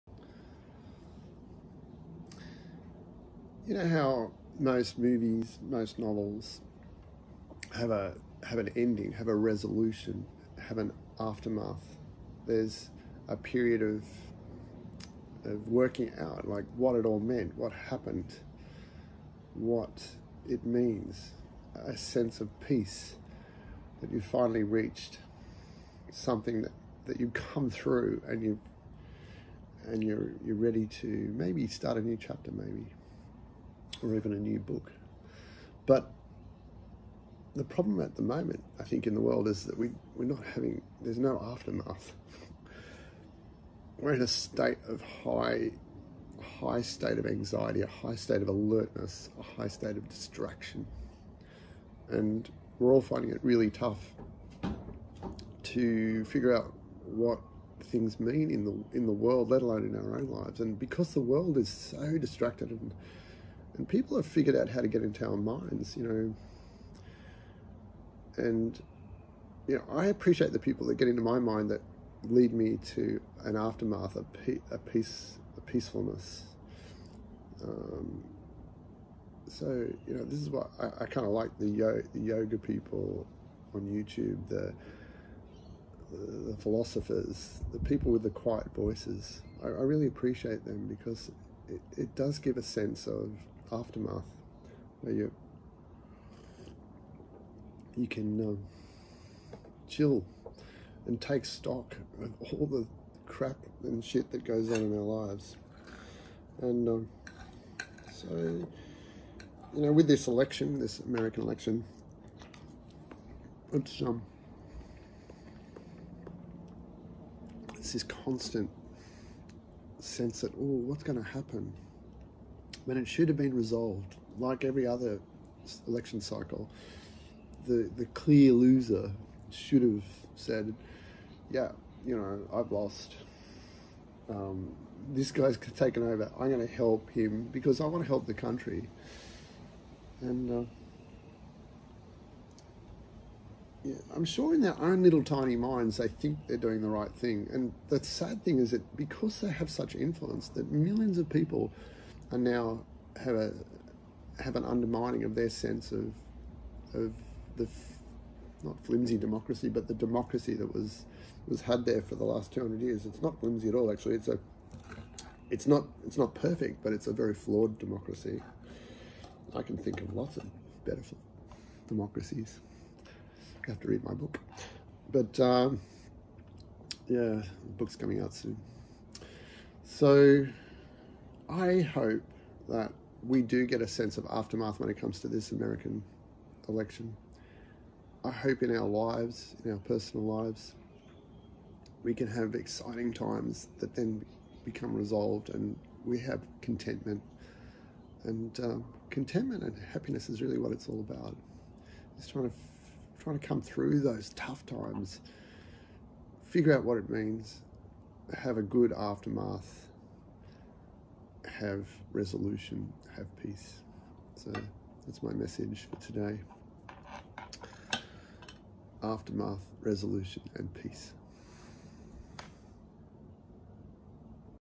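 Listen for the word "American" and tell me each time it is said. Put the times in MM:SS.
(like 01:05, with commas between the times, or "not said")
01:50, 03:05.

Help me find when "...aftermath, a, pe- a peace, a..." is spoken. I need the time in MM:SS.
01:13.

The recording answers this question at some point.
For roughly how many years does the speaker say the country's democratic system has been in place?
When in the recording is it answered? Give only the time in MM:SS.
02:42.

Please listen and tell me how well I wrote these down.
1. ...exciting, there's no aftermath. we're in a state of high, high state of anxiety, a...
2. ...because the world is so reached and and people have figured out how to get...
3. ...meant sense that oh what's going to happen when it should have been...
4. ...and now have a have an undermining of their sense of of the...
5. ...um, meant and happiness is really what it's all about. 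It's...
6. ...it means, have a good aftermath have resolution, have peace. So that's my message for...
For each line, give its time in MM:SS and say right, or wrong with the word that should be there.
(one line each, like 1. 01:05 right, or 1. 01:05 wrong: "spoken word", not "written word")
1. 00:40 wrong: "having", not "exciting"
2. 01:00 wrong: "distracted", not "reached"
3. 01:58 wrong: "constant", not "meant"
4. 02:32 right
5. 03:18 wrong: "contentment", not "meant"
6. 03:26 right.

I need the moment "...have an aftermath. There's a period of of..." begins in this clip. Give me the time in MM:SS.
00:10.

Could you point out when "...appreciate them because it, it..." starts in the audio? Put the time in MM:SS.
01:30.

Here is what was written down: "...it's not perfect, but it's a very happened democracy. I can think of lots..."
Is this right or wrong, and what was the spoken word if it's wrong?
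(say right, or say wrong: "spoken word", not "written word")
wrong: "flawed", not "happened".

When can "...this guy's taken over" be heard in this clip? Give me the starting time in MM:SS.
02:15.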